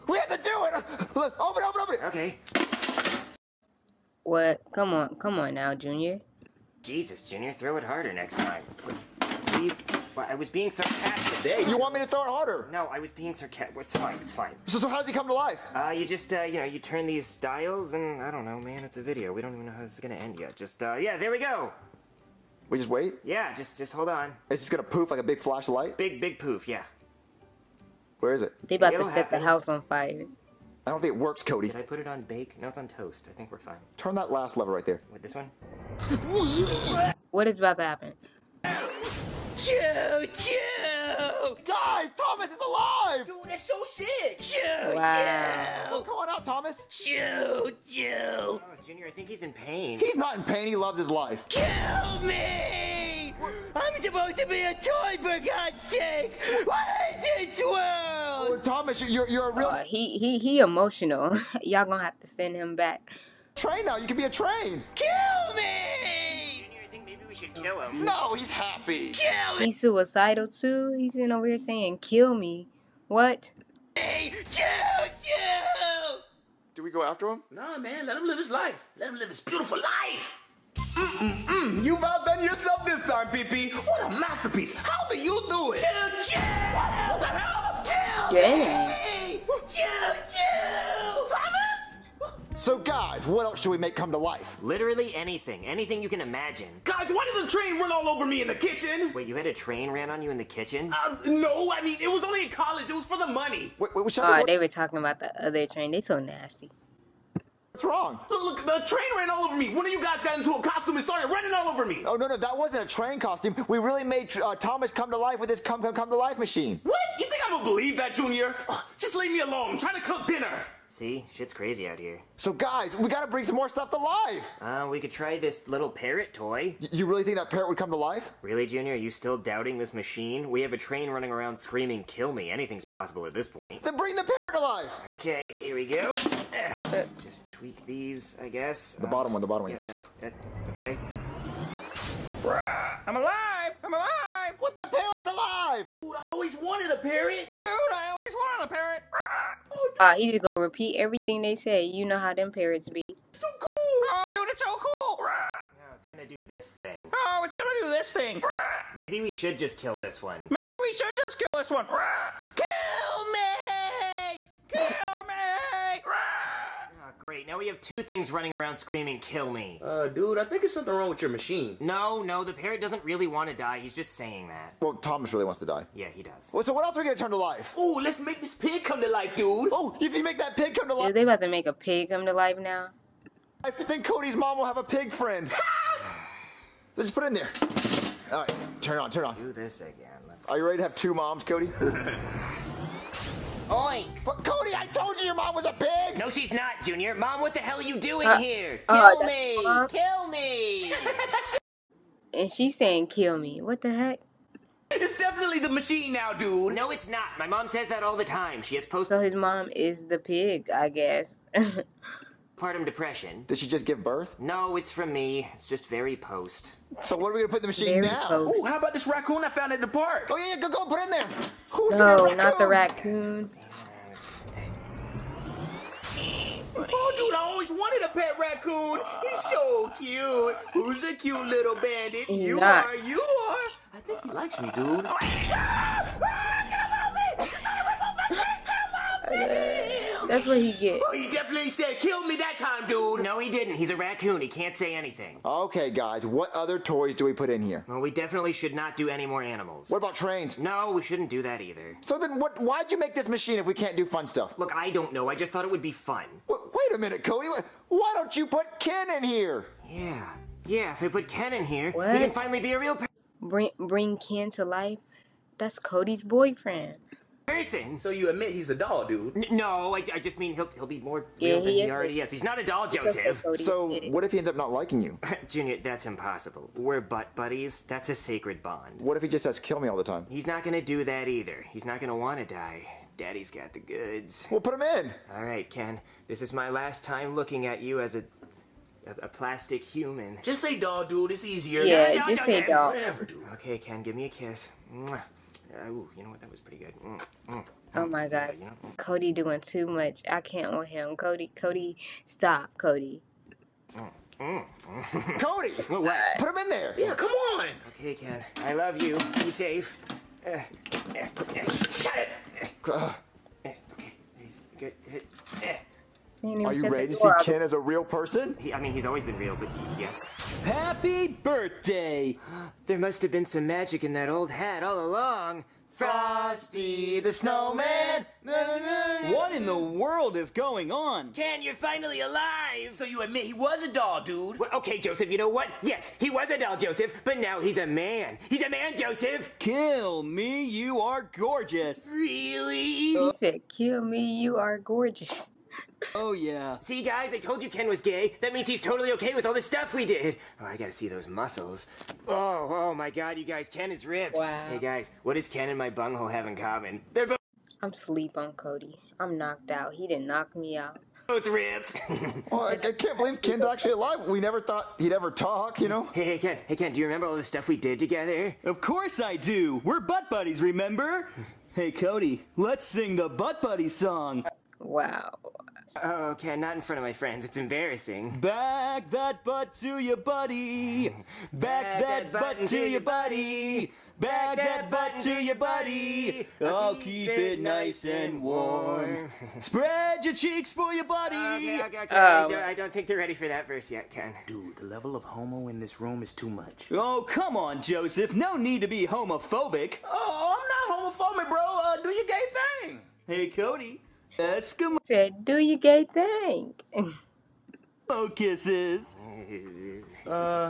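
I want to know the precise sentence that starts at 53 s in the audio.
I'm supposed to be a toy, for God's sake!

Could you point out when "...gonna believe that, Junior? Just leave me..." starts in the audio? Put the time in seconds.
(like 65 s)
117 s.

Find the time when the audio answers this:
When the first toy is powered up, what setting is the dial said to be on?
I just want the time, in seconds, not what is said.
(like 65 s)
32 s.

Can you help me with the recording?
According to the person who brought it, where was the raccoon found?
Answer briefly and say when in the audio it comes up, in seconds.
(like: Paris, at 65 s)
At the park, at 219 s.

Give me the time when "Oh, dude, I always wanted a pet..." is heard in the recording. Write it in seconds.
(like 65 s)
226 s.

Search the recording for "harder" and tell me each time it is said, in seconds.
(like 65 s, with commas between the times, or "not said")
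7 s, 12 s.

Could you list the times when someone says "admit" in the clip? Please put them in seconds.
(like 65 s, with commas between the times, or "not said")
268 s, 333 s.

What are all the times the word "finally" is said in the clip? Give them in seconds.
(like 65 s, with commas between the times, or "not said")
262 s, 331 s.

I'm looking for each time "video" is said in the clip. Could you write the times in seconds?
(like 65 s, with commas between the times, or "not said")
19 s.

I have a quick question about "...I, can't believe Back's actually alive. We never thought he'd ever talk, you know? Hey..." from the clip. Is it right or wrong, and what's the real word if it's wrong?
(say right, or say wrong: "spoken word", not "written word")
wrong: "Ken", not "Back".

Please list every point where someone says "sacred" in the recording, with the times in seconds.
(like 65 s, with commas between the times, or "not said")
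278 s.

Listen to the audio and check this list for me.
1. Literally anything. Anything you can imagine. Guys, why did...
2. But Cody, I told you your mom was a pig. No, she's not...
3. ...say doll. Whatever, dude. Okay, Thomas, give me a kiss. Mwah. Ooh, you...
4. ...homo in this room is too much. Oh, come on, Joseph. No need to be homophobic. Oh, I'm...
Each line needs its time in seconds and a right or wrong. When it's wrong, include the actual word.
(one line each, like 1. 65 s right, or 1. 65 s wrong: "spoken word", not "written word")
1. 94 s right
2. 194 s right
3. 292 s wrong: "Ken", not "Thomas"
4. 395 s right.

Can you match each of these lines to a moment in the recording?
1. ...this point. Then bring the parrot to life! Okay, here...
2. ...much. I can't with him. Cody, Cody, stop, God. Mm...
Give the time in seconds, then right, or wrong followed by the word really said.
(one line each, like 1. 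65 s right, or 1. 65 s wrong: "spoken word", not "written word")
1. 133 s right
2. 299 s wrong: "Cody", not "God".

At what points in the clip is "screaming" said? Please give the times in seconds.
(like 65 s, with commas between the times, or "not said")
131 s, 168 s.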